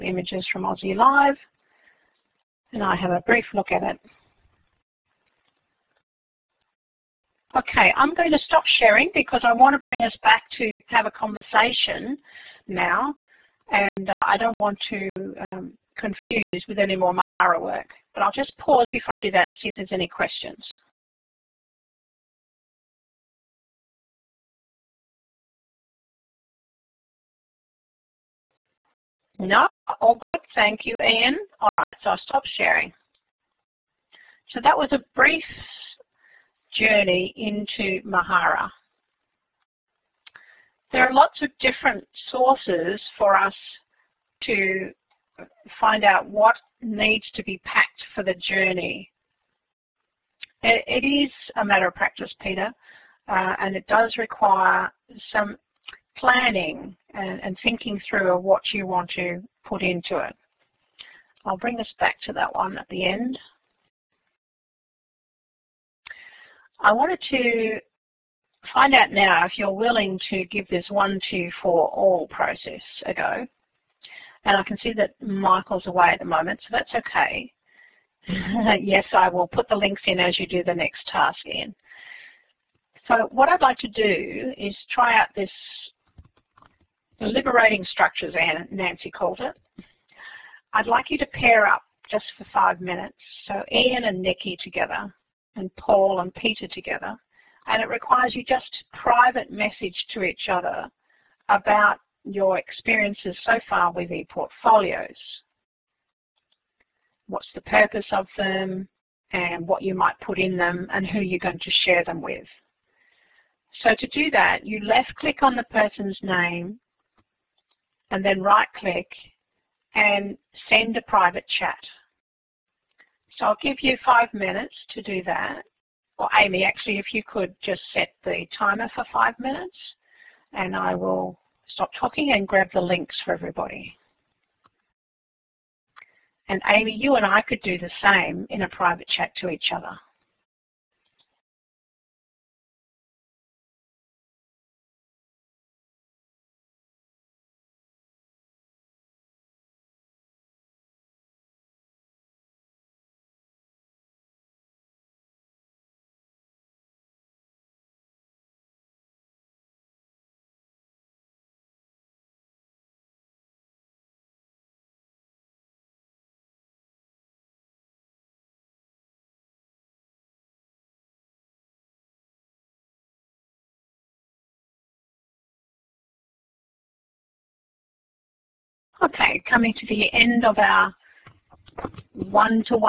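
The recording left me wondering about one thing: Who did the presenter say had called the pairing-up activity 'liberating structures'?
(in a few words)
Nancy.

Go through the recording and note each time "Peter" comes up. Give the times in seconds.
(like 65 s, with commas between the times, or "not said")
52 s, 96 s.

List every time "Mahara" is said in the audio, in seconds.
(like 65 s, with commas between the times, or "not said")
17 s, 38 s.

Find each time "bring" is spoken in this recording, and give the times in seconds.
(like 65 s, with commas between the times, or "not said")
9 s, 61 s.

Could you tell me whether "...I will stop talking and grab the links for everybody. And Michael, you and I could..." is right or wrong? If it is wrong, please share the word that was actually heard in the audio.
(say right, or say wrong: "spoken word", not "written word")
wrong: "Amy", not "Michael".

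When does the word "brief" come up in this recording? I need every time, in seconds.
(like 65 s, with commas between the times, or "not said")
3 s, 35 s.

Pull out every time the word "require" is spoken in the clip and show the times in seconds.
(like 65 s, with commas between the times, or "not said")
54 s, 97 s.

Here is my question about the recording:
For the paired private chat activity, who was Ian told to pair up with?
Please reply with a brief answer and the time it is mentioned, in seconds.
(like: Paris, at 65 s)
Nikki, at 94 s.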